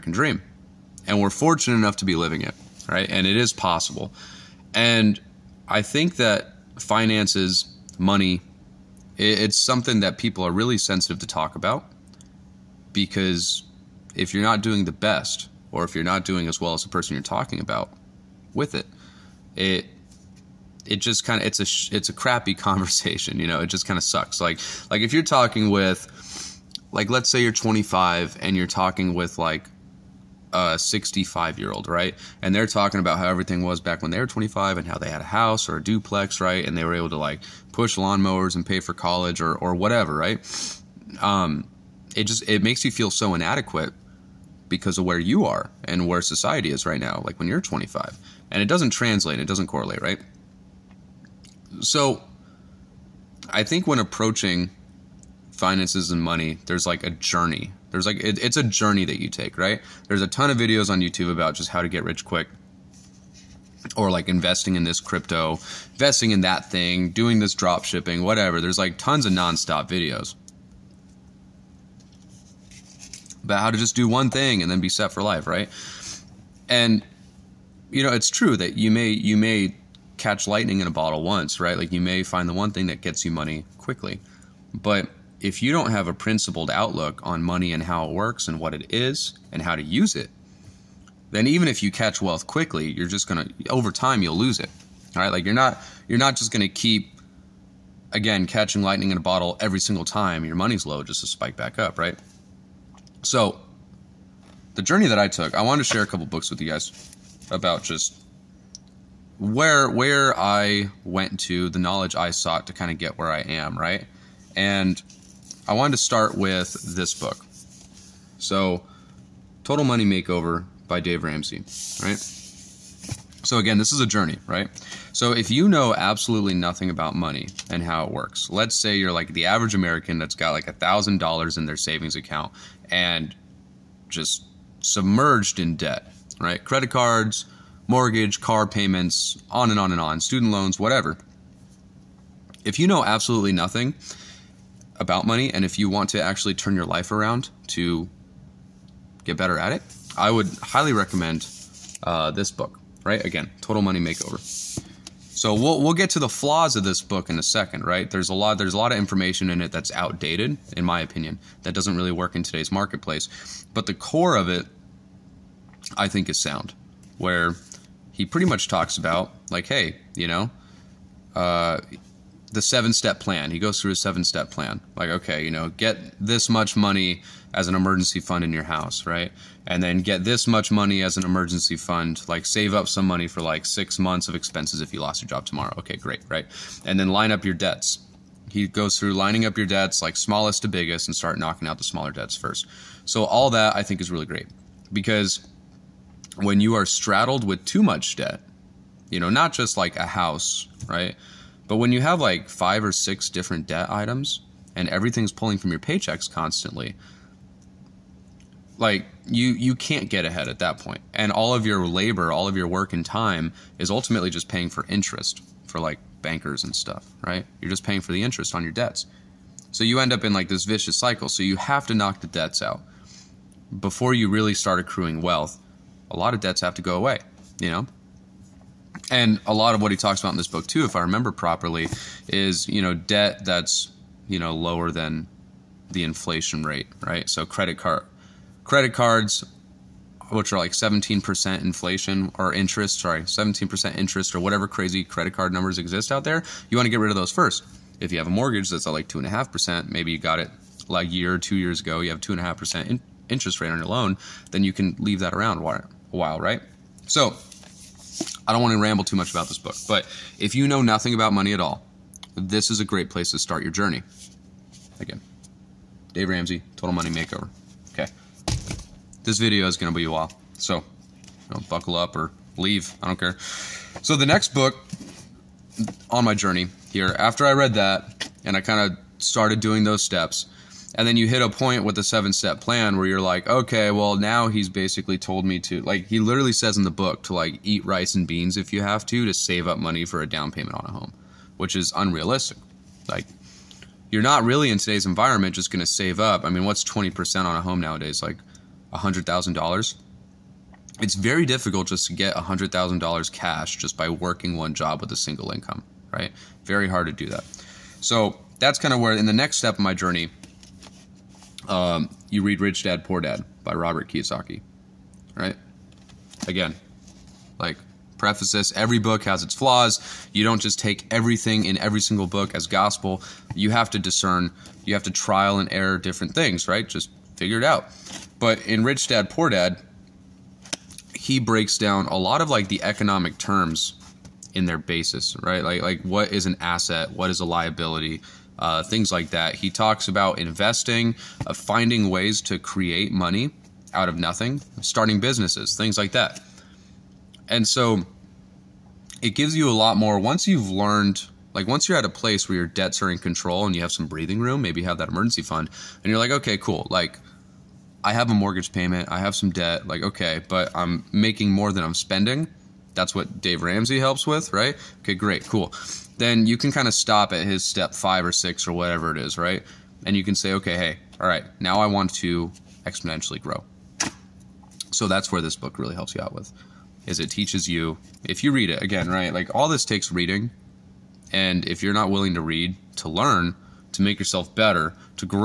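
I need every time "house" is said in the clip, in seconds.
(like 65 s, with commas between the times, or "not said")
35 s, 178 s, 200 s.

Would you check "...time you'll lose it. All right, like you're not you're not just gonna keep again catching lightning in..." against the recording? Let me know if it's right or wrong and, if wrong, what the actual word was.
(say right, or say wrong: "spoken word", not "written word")
right.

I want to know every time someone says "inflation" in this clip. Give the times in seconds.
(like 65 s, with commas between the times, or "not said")
236 s, 241 s.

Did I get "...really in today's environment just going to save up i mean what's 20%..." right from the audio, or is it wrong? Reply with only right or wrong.
right.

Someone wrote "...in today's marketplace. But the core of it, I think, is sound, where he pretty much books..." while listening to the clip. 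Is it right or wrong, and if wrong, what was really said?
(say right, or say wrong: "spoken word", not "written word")
wrong: "talks", not "books".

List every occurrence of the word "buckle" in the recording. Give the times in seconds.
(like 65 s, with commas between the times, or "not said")
271 s.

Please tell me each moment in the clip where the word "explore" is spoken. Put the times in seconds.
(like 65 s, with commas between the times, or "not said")
not said.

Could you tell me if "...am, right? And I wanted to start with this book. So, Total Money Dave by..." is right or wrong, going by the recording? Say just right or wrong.
wrong.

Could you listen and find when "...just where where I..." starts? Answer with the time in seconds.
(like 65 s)
107 s.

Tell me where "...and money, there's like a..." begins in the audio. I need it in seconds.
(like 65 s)
56 s.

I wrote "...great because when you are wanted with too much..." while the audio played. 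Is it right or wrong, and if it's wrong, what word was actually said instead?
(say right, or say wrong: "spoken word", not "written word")
wrong: "straddled", not "wanted".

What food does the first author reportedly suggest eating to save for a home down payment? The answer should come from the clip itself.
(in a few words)
rice and beans.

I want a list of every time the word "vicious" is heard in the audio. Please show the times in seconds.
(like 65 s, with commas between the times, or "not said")
220 s.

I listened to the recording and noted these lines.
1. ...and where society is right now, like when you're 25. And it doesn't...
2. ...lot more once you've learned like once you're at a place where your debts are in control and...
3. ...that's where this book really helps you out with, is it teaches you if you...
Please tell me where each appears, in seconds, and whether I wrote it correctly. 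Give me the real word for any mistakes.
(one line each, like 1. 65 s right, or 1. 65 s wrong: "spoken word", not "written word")
1. 45 s right
2. 349 s right
3. 375 s right.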